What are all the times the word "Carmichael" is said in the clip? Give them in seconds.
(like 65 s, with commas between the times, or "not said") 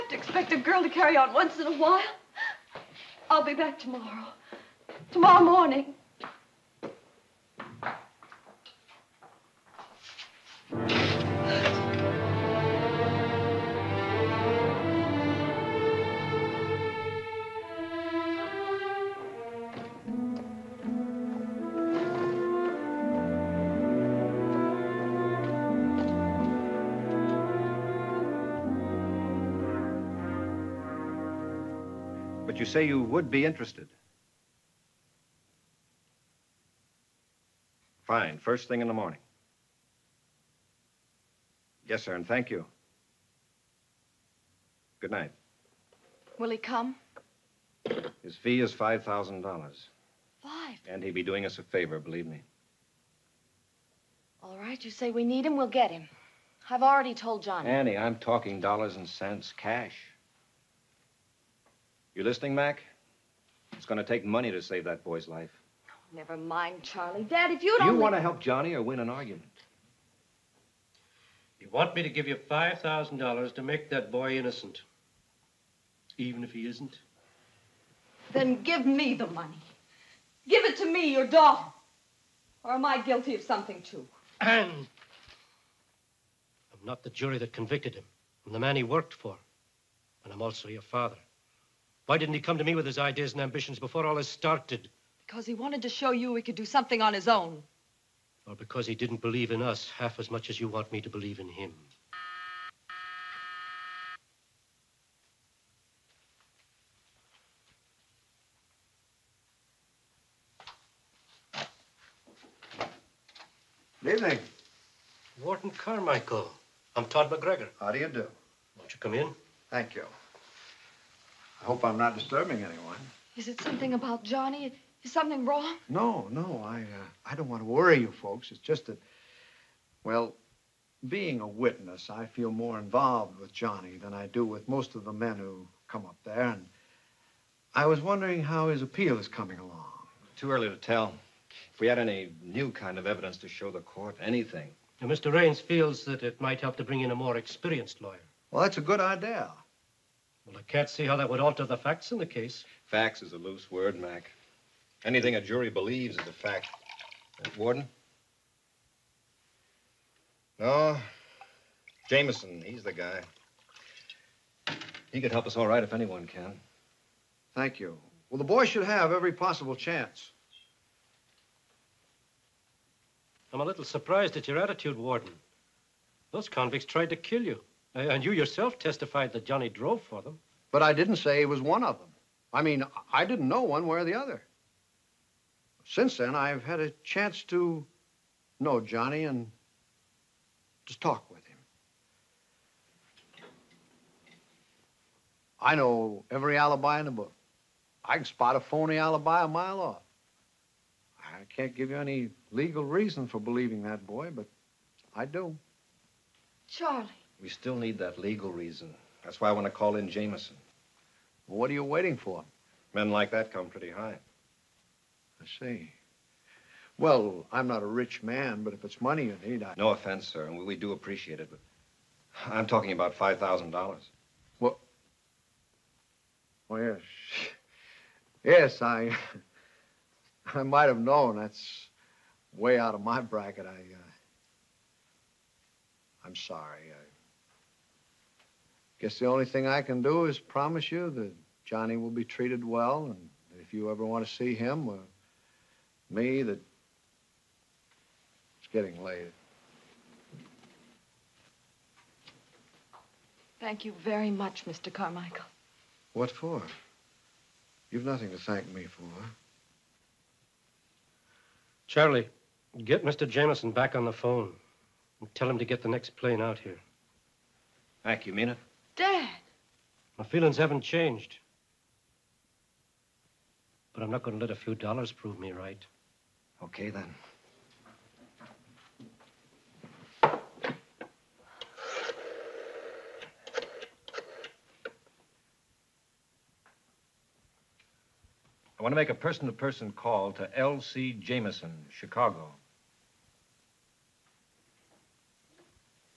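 115 s, 254 s.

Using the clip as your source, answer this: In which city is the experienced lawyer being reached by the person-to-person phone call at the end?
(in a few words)
Chicago.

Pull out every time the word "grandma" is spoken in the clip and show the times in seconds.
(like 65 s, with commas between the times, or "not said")
not said.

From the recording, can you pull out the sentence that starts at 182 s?
I mean, I didn't know one way or the other.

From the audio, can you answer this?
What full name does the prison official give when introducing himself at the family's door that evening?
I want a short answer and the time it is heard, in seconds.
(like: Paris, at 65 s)
Todd McGregor, at 117 s.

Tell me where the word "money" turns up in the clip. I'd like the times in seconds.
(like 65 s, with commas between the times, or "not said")
64 s, 79 s, 219 s.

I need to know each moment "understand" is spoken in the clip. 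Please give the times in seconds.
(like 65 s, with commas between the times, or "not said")
not said.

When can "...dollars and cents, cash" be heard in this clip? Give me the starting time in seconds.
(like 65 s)
58 s.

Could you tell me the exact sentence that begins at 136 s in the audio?
And I was wondering how his appeal is coming along.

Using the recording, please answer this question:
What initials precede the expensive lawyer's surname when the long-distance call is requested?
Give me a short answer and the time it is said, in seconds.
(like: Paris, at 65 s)
L.C., at 290 s.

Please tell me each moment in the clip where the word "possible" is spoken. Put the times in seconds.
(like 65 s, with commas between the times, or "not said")
169 s.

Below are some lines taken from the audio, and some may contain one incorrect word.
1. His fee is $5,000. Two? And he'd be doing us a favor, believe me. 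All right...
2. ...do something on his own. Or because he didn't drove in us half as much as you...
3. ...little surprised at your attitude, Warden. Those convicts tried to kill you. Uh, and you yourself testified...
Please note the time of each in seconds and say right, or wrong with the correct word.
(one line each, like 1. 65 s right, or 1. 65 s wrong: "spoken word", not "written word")
1. 48 s wrong: "Five", not "Two"
2. 96 s wrong: "believe", not "drove"
3. 173 s right.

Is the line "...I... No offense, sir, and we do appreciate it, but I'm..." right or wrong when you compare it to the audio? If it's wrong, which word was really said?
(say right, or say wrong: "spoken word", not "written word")
right.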